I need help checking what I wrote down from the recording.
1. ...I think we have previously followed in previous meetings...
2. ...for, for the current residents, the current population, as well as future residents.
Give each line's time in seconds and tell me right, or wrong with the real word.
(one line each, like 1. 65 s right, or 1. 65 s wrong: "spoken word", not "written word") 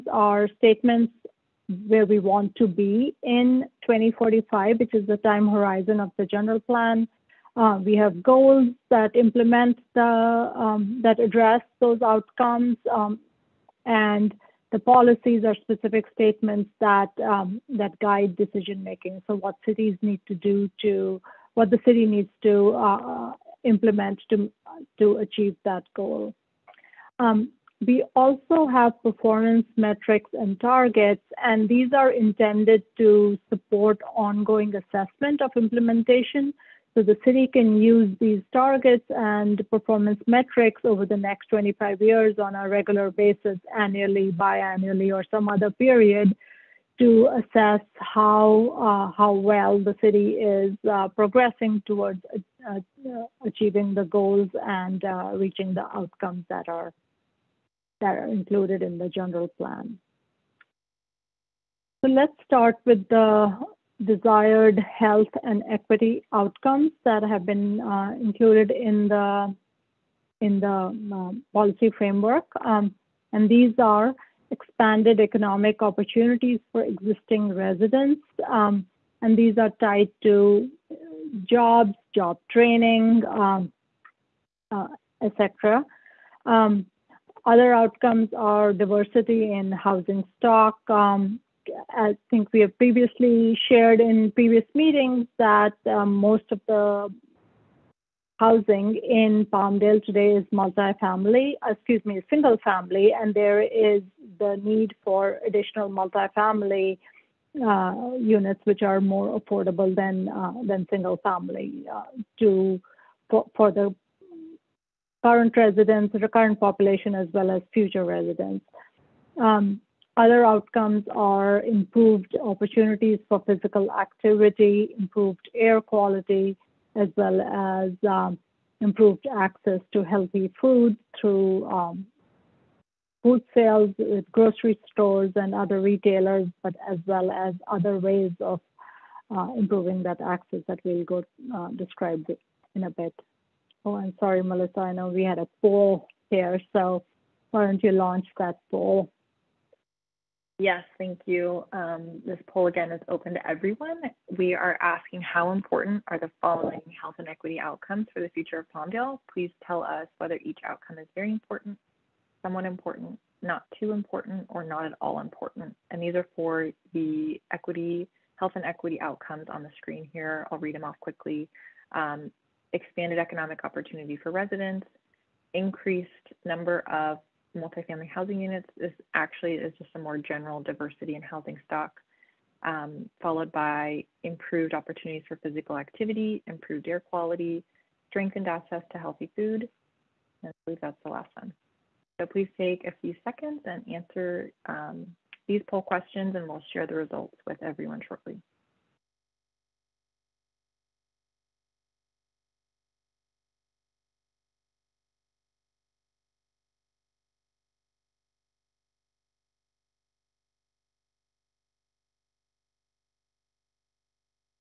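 1. 91 s wrong: "shared", not "followed"
2. 113 s right.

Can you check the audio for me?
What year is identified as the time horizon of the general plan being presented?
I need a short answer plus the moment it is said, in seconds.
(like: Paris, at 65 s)
2045, at 3 s.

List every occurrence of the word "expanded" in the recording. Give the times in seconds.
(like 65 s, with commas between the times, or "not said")
74 s, 172 s.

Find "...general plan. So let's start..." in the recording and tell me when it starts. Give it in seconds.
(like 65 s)
59 s.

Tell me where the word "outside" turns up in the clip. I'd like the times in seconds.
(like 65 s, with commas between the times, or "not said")
not said.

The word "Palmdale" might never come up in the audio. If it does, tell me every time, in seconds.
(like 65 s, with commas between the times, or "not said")
99 s, 158 s.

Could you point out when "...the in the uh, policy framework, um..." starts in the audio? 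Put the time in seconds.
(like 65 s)
69 s.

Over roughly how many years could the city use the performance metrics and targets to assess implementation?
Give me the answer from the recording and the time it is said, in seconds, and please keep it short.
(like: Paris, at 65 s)
25, at 41 s.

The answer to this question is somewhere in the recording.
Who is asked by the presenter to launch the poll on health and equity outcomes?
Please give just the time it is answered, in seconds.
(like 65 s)
144 s.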